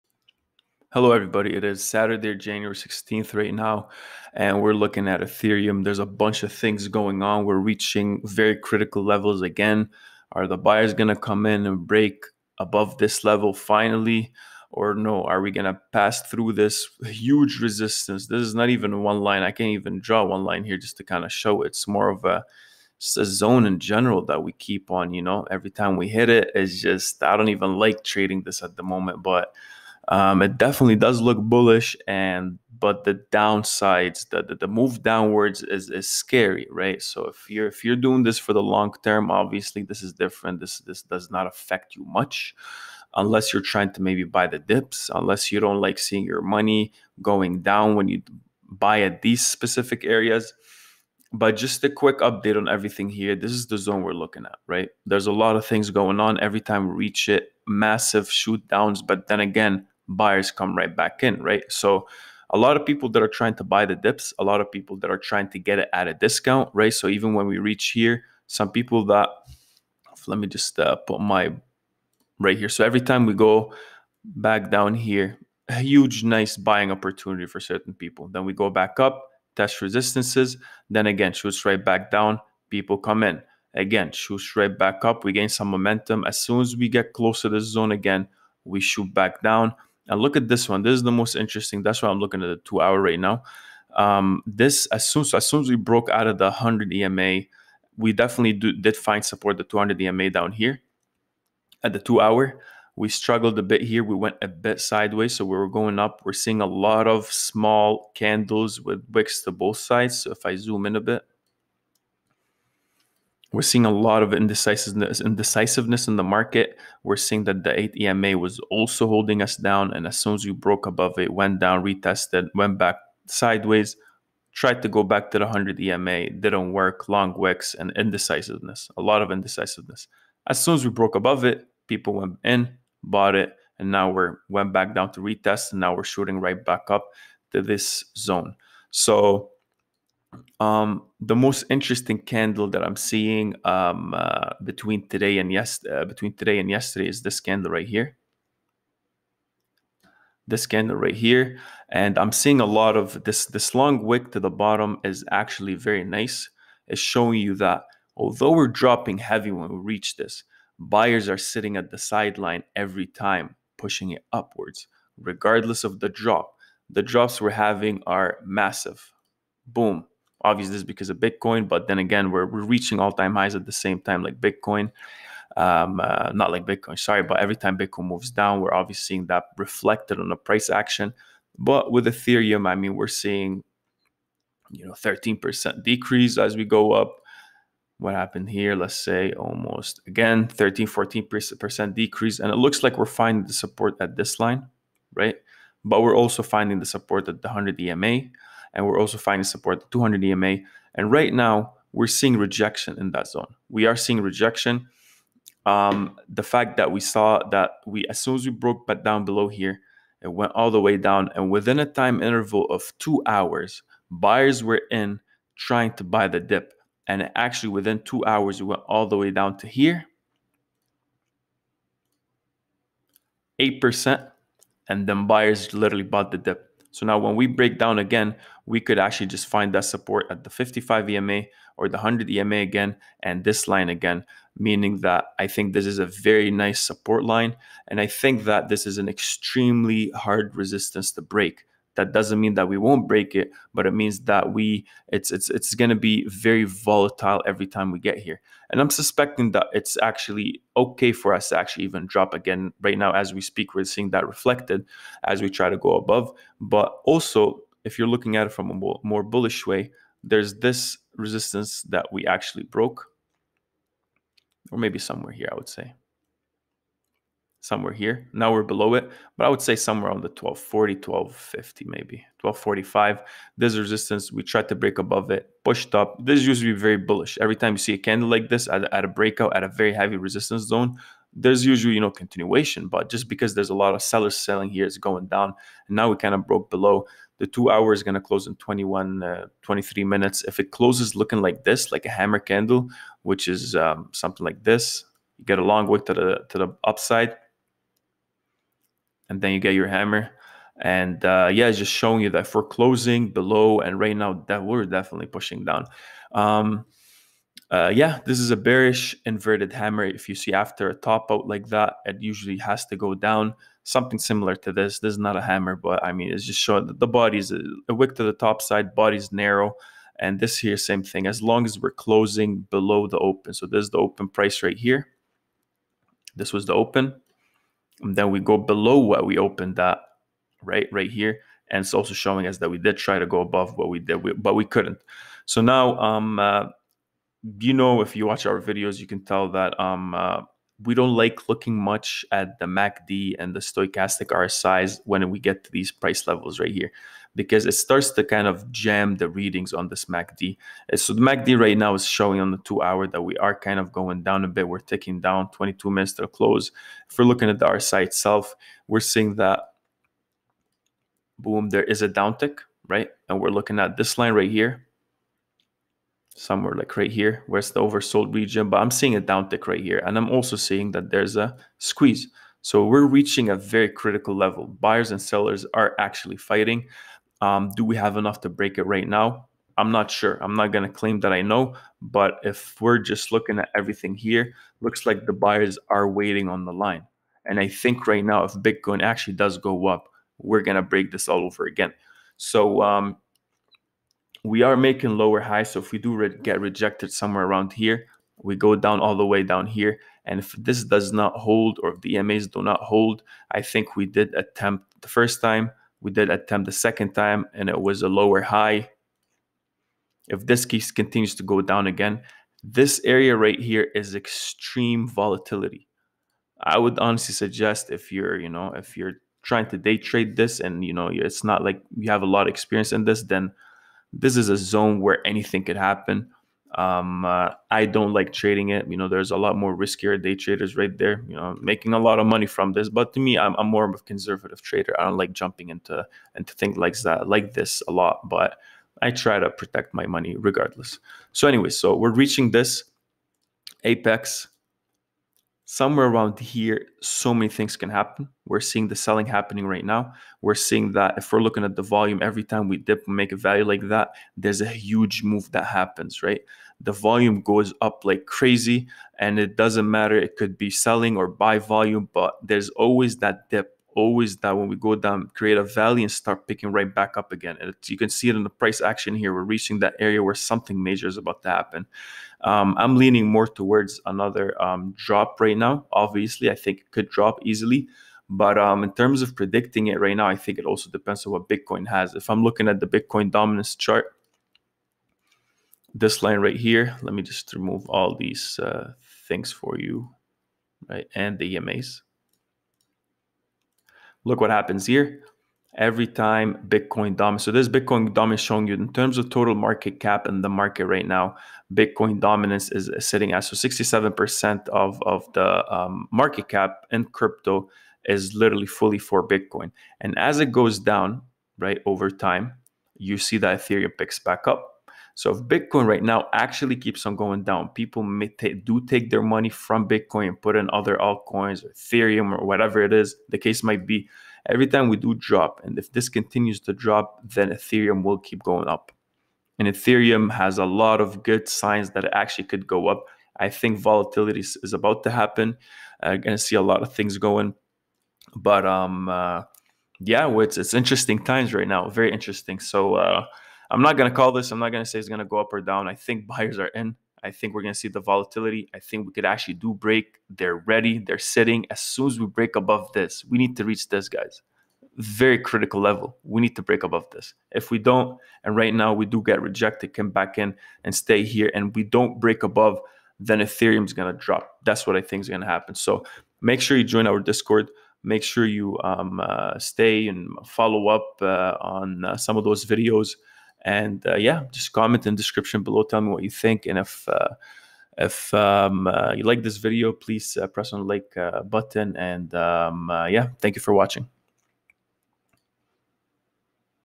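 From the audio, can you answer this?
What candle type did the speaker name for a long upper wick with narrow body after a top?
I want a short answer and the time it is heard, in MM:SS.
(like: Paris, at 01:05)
Bearish inverted hammer, at 05:08.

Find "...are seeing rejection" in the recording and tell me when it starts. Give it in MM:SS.
03:23.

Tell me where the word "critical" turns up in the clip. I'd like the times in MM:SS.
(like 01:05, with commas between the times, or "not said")
00:08, 06:13, 09:15.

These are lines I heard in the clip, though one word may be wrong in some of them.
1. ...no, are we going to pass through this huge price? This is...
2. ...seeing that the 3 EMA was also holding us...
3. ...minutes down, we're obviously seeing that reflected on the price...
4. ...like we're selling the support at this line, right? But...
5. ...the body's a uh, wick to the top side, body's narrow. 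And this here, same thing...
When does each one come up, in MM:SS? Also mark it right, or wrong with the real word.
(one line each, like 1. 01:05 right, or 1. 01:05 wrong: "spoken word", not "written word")
1. 00:14 wrong: "resistance", not "price"
2. 01:57 wrong: "8", not "3"
3. 02:58 wrong: "moves", not "minutes"
4. 03:12 wrong: "finding", not "selling"
5. 05:16 right.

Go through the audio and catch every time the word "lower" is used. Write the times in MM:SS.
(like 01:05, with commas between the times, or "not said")
06:35, 06:48.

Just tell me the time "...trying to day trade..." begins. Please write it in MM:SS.
06:59.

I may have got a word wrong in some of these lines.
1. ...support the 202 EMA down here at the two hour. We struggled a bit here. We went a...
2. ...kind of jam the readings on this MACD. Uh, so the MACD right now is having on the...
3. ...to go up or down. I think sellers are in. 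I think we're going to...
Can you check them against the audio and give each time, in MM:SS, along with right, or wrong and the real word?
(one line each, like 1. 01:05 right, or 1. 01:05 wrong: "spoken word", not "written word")
1. 01:39 wrong: "200", not "202"
2. 05:48 wrong: "showing", not "having"
3. 09:05 wrong: "buyers", not "sellers".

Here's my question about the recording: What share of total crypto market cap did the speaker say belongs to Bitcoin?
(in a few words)
67%.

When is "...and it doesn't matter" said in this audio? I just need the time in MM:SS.
07:39.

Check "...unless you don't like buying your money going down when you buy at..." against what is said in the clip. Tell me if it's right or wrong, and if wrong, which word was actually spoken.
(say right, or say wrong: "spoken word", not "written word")
wrong: "seeing", not "buying".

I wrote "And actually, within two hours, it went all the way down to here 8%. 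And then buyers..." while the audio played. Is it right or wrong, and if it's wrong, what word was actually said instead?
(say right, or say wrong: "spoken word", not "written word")
right.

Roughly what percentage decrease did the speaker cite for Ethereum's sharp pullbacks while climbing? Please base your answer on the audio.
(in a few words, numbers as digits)
13%.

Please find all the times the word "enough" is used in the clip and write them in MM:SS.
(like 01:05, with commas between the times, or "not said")
06:18.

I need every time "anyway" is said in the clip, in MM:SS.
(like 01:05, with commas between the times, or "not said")
07:21.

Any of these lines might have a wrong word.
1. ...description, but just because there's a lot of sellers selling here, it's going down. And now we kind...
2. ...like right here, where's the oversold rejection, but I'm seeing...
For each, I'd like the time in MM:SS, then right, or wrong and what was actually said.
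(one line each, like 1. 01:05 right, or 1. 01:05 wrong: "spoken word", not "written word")
1. 04:42 wrong: "continuation", not "description"
2. 06:06 wrong: "region", not "rejection".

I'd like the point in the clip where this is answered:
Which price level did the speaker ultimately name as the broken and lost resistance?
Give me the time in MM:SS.
04:32.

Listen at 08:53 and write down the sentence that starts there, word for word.
I think volatility is about to happen.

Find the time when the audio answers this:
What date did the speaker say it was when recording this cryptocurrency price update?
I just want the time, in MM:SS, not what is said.
00:01.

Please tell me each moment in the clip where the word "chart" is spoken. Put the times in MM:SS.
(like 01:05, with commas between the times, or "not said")
08:03.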